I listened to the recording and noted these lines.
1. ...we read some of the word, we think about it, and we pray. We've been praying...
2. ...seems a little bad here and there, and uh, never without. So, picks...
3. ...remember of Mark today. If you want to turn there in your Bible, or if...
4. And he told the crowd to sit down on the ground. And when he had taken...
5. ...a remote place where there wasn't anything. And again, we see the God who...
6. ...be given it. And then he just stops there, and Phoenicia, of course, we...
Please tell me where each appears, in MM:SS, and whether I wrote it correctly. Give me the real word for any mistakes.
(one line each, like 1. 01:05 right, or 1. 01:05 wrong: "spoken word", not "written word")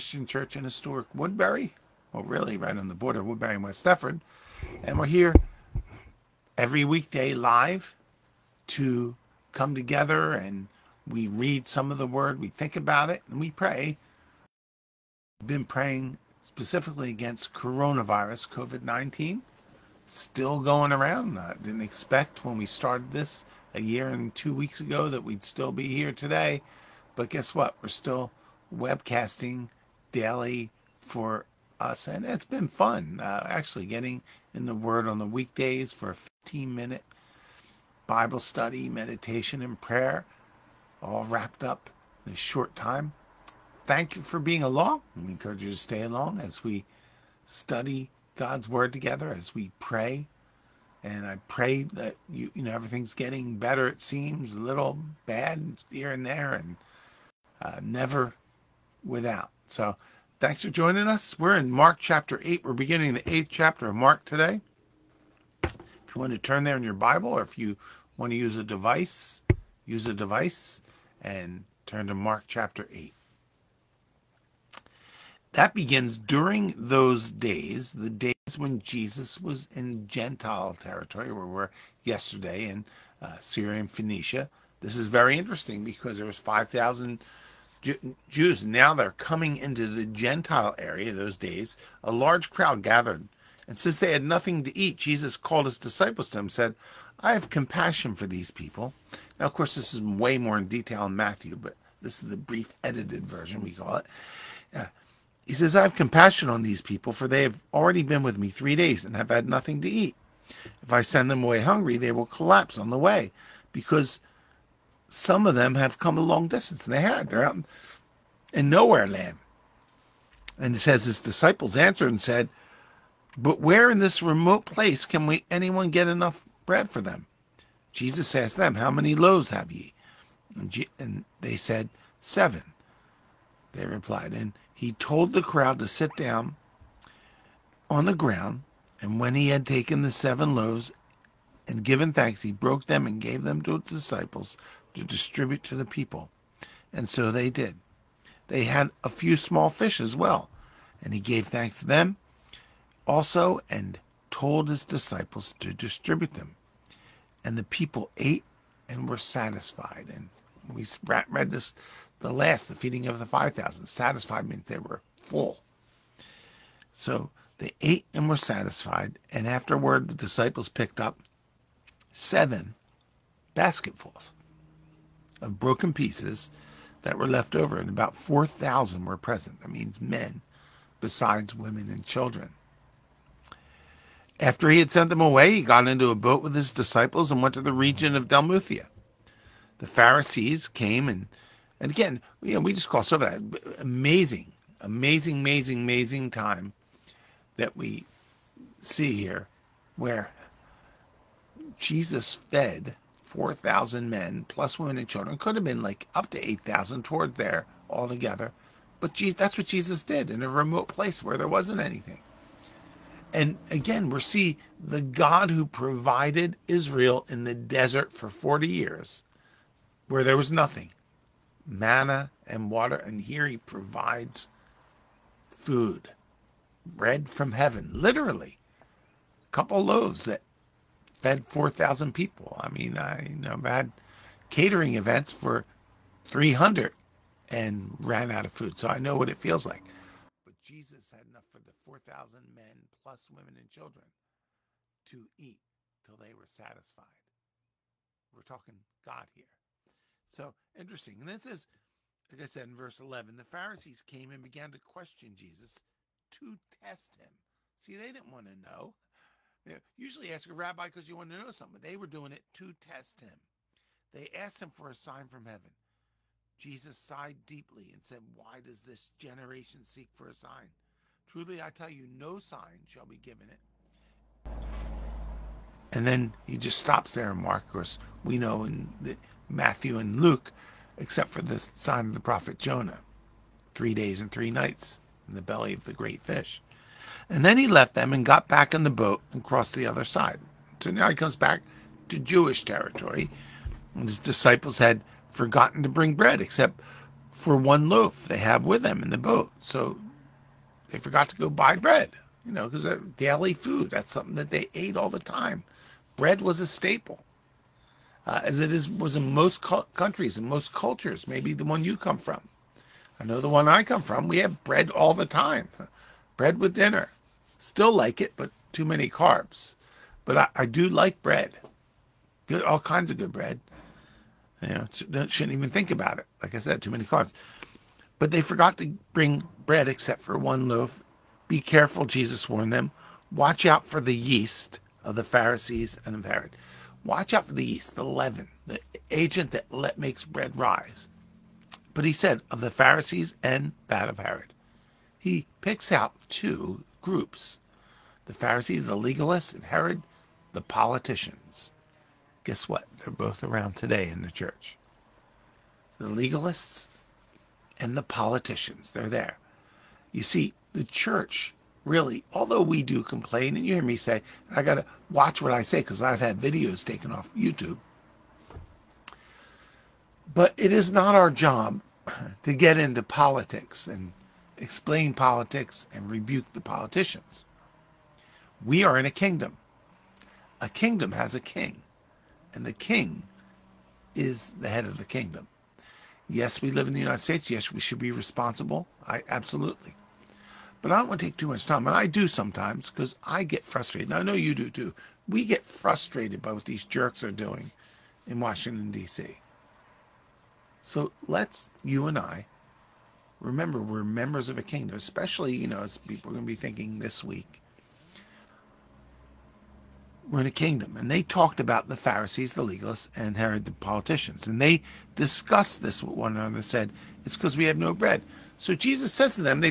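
1. 00:11 right
2. 00:54 wrong: "thanks", not "picks"
3. 01:03 wrong: "chapter", not "remember"
4. 02:14 right
5. 03:30 right
6. 04:33 wrong: "Mark", not "Phoenicia".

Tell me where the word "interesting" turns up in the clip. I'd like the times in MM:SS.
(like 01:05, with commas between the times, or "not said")
01:25, 04:10.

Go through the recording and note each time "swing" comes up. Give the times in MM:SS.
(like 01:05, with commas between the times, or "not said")
not said.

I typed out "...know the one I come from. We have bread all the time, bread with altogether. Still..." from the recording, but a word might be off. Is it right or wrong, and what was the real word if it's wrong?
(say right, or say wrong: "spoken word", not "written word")
wrong: "dinner", not "altogether".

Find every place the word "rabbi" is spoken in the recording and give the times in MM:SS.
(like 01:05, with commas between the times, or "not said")
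04:20.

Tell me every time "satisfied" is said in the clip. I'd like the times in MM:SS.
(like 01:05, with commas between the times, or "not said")
02:39, 02:43, 02:48, 04:06.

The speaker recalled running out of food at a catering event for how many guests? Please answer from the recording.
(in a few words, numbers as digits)
300.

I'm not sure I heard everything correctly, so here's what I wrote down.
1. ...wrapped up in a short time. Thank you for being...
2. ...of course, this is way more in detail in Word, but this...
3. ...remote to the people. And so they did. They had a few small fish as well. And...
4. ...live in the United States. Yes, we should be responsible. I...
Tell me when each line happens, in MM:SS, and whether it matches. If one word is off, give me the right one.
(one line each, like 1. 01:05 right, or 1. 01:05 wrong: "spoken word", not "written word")
1. 00:41 right
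2. 01:39 wrong: "Matthew", not "Word"
3. 02:25 wrong: "distribute", not "remote"
4. 06:26 right.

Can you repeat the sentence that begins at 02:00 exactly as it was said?
And he says, His disciples answered and said, But where in this remote place can we anyone get enough bread for them?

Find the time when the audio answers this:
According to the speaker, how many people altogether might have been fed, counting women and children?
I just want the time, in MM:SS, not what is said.
03:26.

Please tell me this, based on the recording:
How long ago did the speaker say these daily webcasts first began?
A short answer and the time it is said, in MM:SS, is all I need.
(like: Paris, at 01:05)
a year and two weeks, at 00:23.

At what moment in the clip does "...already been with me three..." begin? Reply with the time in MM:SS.
01:47.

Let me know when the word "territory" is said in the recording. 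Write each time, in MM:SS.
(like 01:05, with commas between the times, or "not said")
01:20, 04:52.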